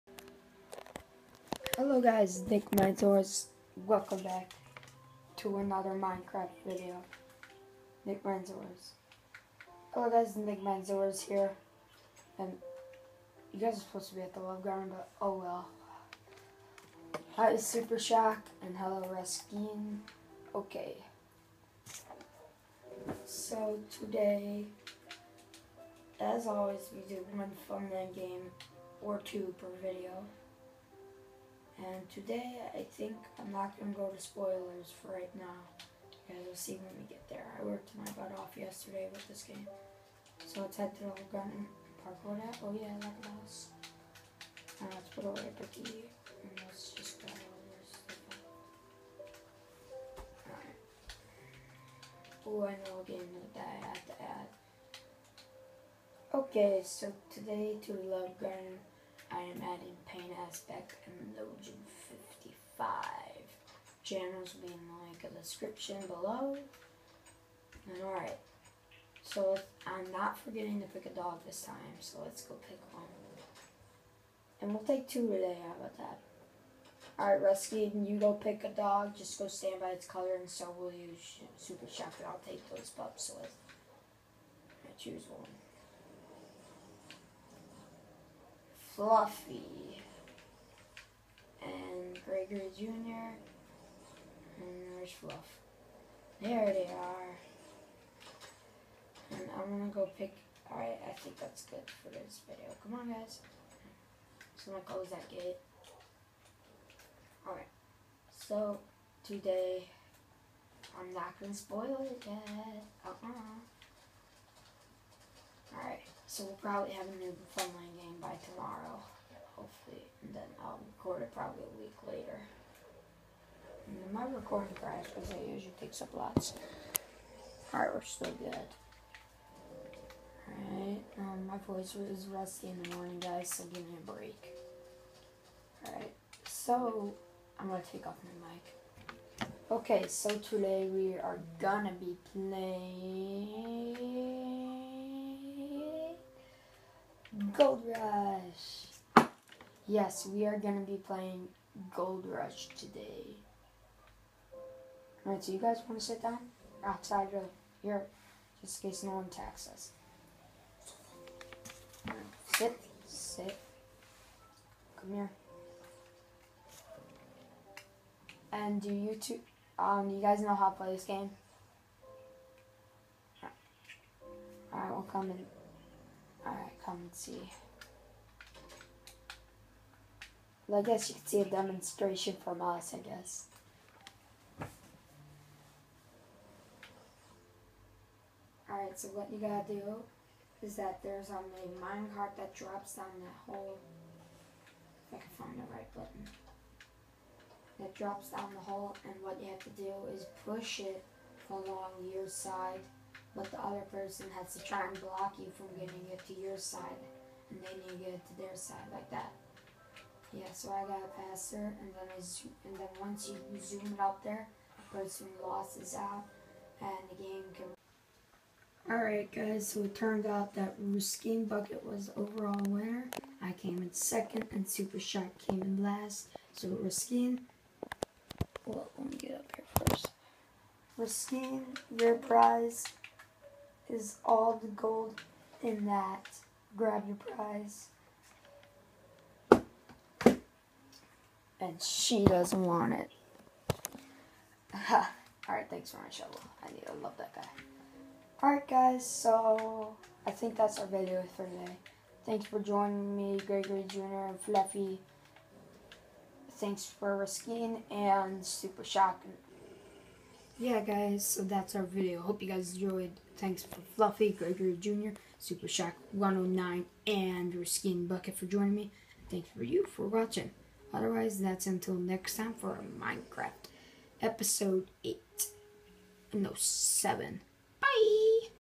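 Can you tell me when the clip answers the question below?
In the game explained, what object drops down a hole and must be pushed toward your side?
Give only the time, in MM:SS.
03:11.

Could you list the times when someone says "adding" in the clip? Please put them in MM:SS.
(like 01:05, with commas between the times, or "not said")
00:59.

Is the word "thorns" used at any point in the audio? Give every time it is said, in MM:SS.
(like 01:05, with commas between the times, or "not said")
not said.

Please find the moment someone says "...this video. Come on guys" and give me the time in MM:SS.
01:42.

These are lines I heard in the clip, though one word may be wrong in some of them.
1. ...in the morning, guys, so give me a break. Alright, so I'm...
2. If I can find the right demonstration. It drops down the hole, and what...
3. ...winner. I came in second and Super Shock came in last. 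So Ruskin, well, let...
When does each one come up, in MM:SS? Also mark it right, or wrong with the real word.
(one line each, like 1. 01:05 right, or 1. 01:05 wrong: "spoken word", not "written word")
1. 02:12 right
2. 03:15 wrong: "button", not "demonstration"
3. 03:42 right.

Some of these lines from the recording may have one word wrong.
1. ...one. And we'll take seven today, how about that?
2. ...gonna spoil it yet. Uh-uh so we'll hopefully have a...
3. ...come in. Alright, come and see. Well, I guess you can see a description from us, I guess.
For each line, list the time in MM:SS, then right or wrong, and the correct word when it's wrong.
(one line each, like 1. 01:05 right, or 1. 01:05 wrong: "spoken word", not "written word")
1. 01:12 wrong: "two", not "seven"
2. 01:51 wrong: "probably", not "hopefully"
3. 02:55 wrong: "demonstration", not "description".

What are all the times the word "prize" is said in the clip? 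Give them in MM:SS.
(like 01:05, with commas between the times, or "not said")
03:52, 03:57.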